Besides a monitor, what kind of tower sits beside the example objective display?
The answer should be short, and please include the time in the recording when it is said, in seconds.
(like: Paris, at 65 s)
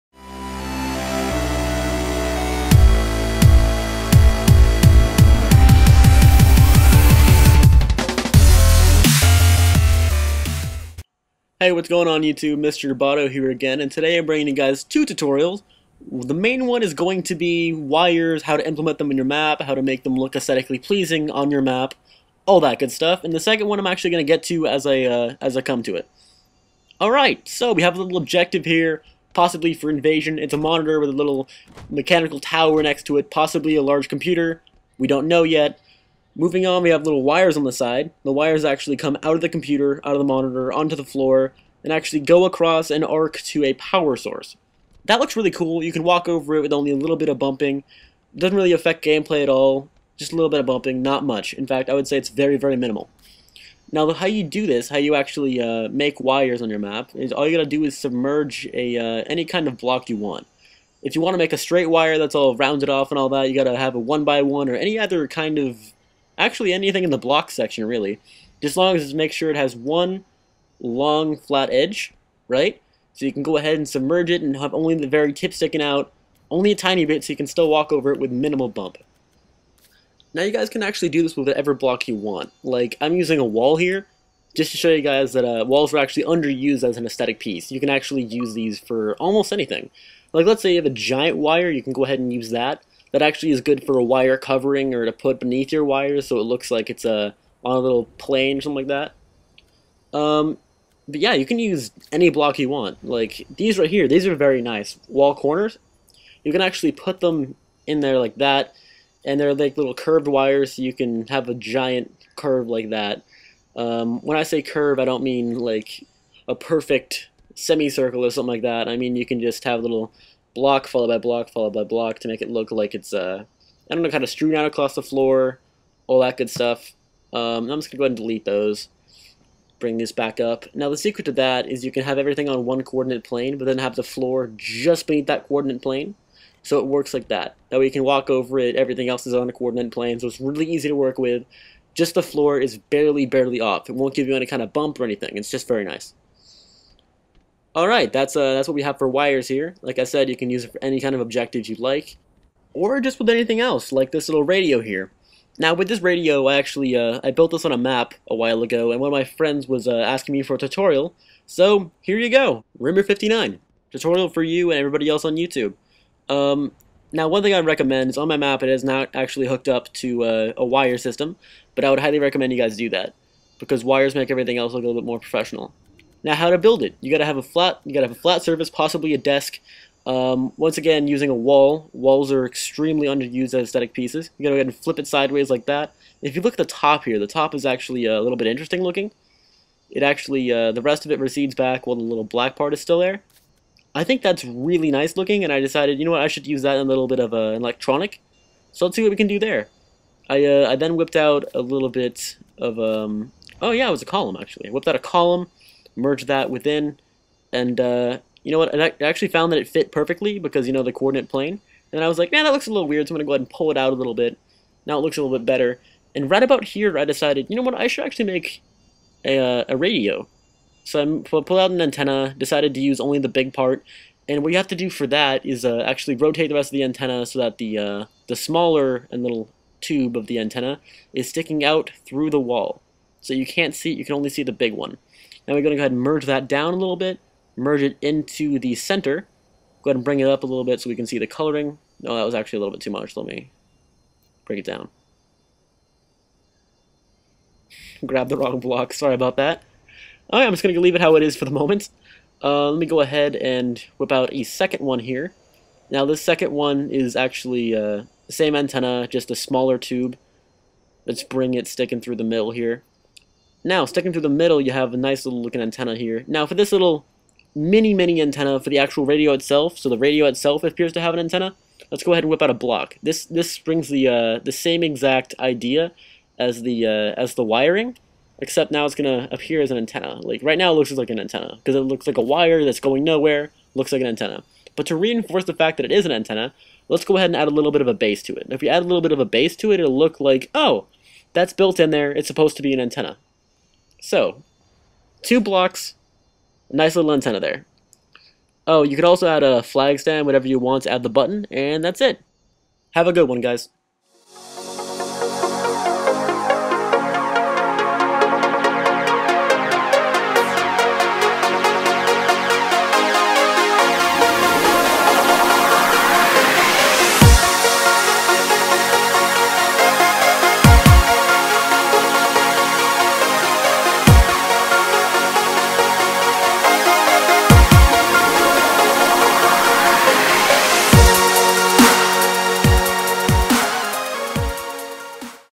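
mechanical tower, at 31 s.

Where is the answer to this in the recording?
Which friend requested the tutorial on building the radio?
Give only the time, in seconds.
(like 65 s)
162 s.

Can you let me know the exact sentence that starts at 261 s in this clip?
Let's bring it sticking through the middle here.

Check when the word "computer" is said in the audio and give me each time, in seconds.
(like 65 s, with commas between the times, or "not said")
34 s, 39 s.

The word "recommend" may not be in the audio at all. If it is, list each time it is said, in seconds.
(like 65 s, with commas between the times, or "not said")
167 s, 172 s.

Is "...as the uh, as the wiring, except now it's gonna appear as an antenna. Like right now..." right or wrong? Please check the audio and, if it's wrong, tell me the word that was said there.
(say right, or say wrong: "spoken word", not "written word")
right.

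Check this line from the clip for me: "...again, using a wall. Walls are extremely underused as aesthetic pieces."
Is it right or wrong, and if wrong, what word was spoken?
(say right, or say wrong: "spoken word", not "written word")
right.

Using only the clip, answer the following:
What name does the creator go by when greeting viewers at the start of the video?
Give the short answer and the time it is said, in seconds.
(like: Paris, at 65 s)
Mr. Roboto, at 12 s.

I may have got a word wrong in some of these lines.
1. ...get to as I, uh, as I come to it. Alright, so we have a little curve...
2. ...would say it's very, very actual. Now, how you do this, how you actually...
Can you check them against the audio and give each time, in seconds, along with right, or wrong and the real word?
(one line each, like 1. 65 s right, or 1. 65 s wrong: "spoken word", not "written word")
1. 24 s wrong: "objective", not "curve"
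2. 51 s wrong: "minimal", not "actual".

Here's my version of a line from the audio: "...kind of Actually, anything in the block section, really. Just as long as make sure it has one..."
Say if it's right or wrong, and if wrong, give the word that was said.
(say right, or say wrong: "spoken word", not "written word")
right.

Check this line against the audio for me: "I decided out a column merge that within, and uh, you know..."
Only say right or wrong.
wrong.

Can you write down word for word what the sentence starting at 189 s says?
It actually, uh, the rest of it recedes back while the little black part is still there.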